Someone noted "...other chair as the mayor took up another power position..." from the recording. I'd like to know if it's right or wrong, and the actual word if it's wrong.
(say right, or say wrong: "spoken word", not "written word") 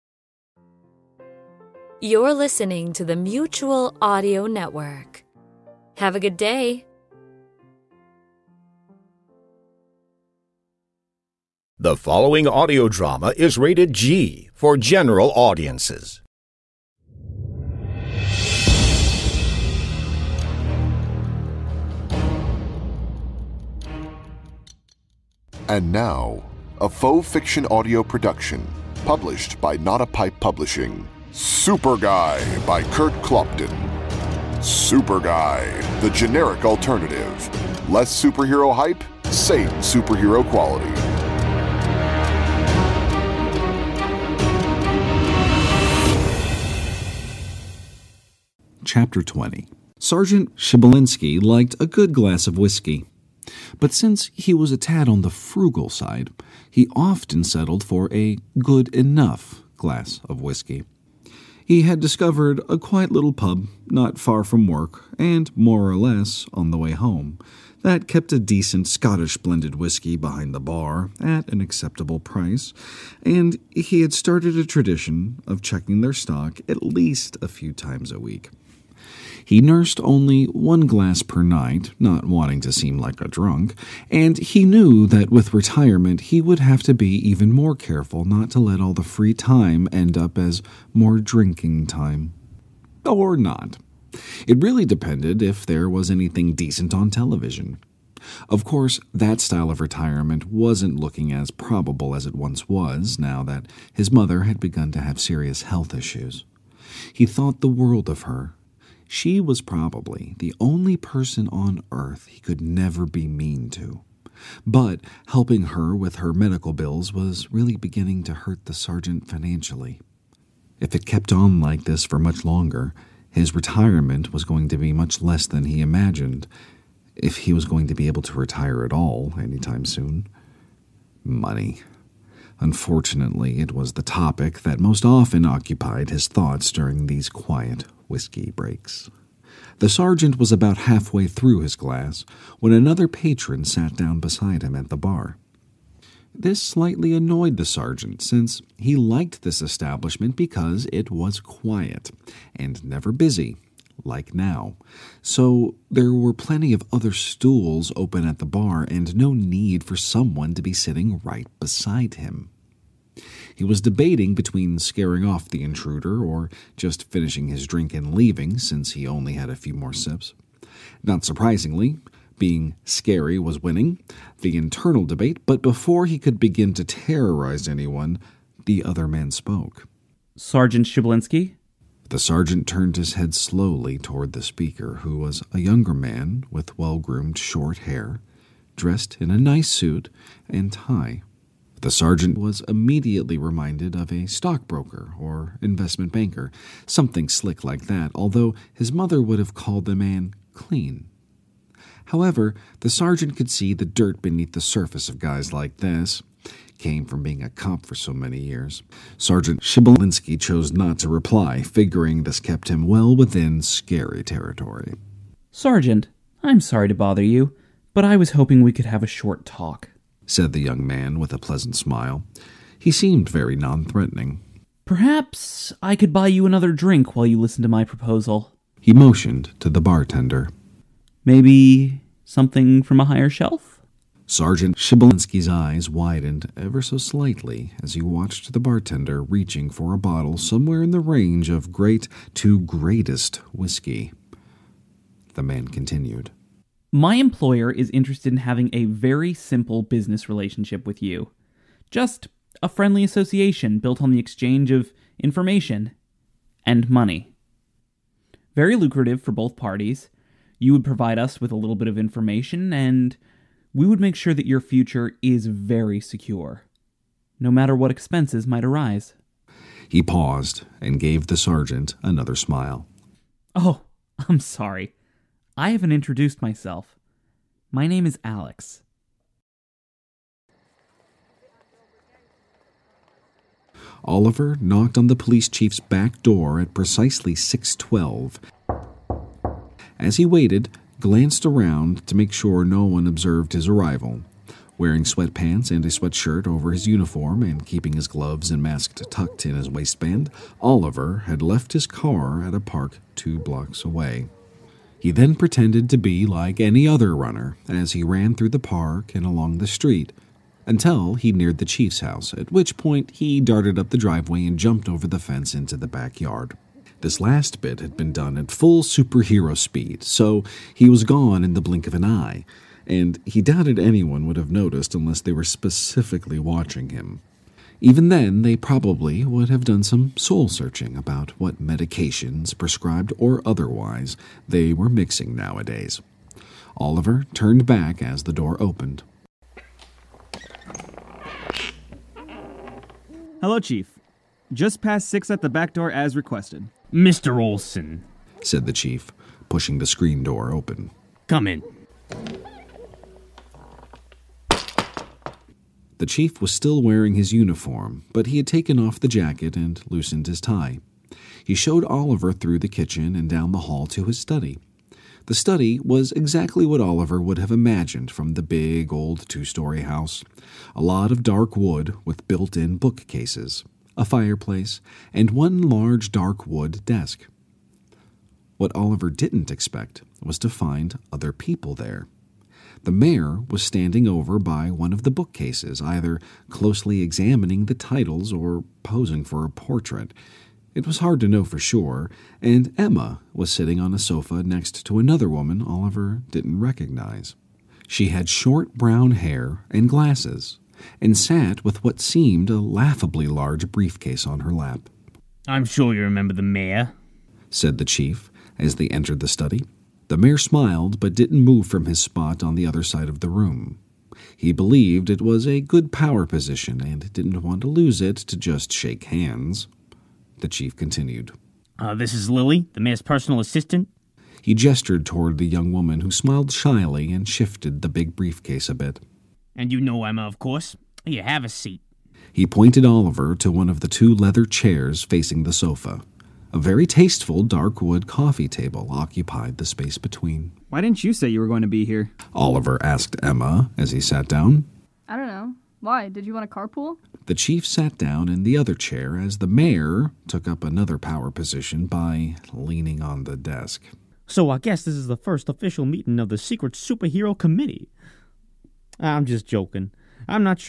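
right.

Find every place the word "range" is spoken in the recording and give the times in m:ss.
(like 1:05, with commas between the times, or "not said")
4:00.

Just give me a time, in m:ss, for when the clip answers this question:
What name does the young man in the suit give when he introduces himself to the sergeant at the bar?
4:38.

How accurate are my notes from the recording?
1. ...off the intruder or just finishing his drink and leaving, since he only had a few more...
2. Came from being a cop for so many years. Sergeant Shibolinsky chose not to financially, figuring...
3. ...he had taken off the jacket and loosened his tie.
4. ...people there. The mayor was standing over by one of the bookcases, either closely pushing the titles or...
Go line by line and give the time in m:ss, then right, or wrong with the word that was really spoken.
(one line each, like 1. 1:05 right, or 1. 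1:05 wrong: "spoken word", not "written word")
1. 2:45 right
2. 3:26 wrong: "reply", not "financially"
3. 5:58 right
4. 6:21 wrong: "examining", not "pushing".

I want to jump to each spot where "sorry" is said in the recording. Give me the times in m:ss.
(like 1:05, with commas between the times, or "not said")
3:36, 4:34.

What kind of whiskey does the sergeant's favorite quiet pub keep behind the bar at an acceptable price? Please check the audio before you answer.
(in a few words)
Scottish blended whiskey.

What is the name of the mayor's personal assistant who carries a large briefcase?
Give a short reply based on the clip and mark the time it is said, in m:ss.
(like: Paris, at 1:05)
Lily, at 7:02.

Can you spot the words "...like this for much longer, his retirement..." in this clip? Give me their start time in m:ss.
2:01.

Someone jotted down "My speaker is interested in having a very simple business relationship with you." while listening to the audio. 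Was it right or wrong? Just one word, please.
wrong.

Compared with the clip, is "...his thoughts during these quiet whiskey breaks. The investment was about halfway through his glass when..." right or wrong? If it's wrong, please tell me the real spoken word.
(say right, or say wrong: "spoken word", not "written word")
wrong: "sergeant", not "investment".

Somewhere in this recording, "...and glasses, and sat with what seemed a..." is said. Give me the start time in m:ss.
6:39.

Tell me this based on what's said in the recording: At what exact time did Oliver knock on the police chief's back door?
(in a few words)
6:12.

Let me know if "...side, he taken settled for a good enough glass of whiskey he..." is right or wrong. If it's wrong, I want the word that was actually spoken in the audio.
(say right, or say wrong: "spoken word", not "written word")
wrong: "often", not "taken".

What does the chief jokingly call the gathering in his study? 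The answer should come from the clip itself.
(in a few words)
Secret superhero committee.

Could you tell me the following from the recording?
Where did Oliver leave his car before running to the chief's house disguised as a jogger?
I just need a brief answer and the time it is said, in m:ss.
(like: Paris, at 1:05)
At a park two blocks away, at 5:02.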